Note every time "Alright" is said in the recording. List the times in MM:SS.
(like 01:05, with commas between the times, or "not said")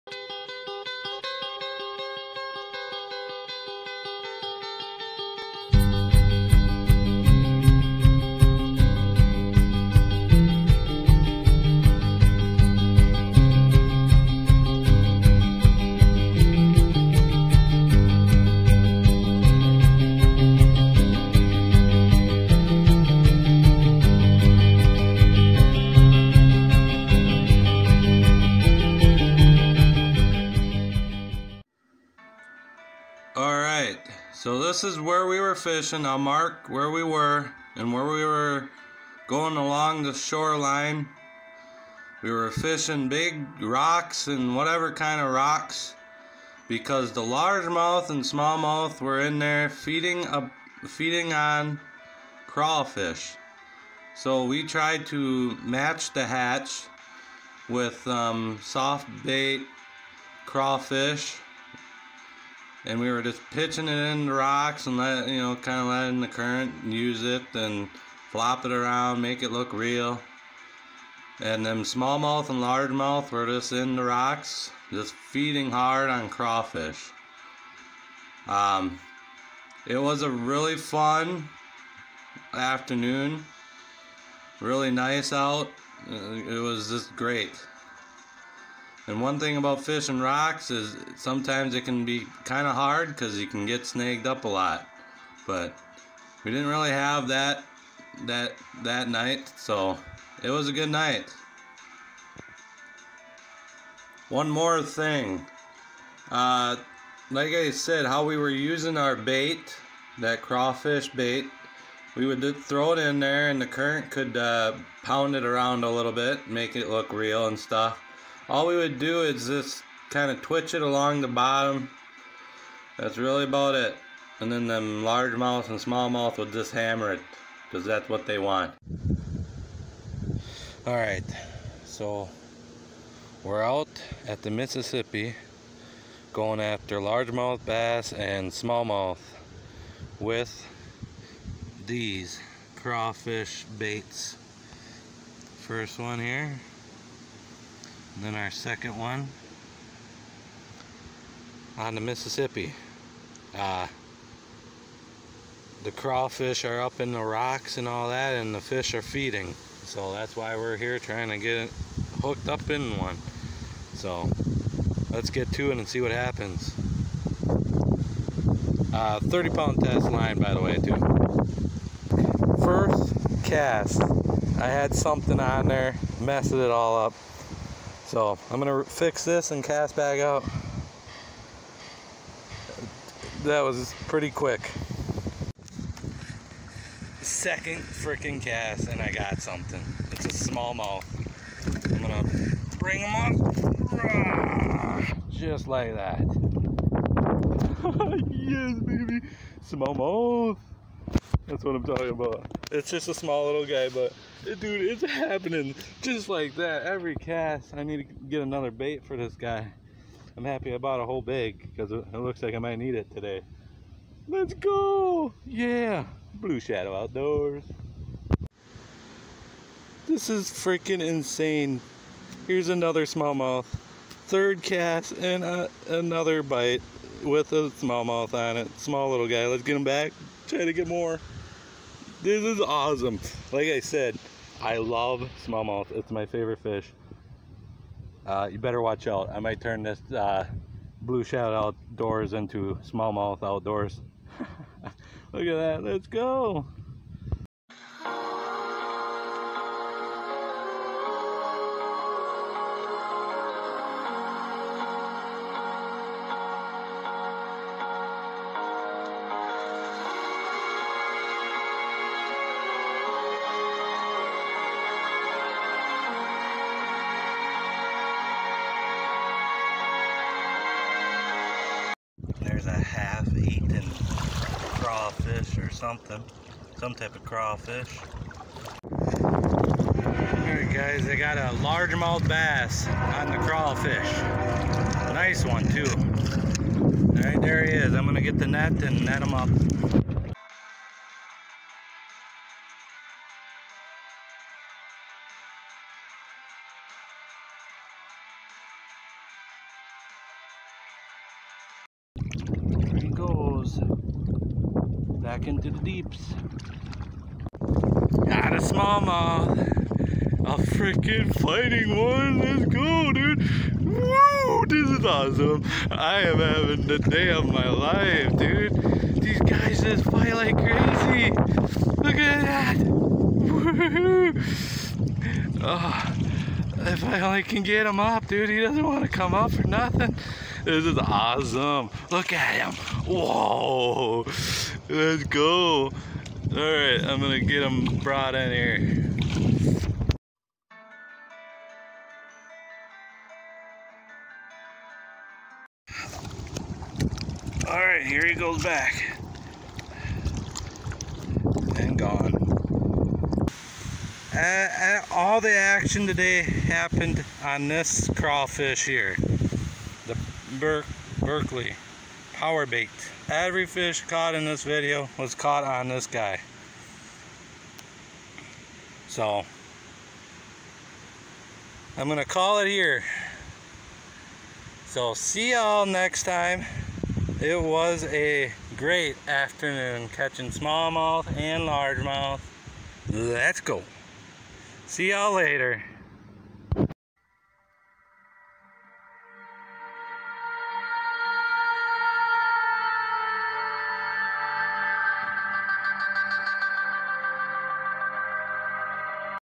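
04:40, 04:47.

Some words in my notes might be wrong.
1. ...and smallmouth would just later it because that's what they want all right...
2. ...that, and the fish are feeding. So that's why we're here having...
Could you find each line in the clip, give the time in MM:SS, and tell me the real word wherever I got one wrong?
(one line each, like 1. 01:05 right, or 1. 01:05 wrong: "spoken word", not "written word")
1. 02:05 wrong: "hammer", not "later"
2. 02:38 wrong: "trying", not "having".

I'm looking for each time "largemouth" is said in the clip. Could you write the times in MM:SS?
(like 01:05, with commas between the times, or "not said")
00:47, 01:12, 02:05, 02:16, 04:41, 06:21.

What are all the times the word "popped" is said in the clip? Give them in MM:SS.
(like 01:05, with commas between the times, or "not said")
not said.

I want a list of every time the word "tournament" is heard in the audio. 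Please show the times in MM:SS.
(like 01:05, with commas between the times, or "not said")
not said.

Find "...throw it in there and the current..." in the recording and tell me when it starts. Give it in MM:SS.
01:52.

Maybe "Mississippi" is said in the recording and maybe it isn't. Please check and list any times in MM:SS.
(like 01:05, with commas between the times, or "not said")
02:14, 02:32.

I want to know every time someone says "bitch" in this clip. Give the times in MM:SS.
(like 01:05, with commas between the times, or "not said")
not said.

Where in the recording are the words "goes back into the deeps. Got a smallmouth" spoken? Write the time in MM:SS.
05:03.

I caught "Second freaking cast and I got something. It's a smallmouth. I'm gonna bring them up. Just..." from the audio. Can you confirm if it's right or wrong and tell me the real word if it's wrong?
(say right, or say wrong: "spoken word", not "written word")
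right.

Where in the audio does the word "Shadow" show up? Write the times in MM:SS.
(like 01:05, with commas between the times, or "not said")
03:36, 04:01.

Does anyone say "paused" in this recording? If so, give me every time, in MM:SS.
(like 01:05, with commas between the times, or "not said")
not said.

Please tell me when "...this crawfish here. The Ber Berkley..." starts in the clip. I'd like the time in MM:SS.
05:57.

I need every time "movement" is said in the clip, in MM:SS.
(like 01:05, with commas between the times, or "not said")
not said.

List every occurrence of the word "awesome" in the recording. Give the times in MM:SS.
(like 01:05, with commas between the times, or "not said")
03:52, 05:15, 05:30.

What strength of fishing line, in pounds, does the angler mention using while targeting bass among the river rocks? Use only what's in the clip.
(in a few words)
30.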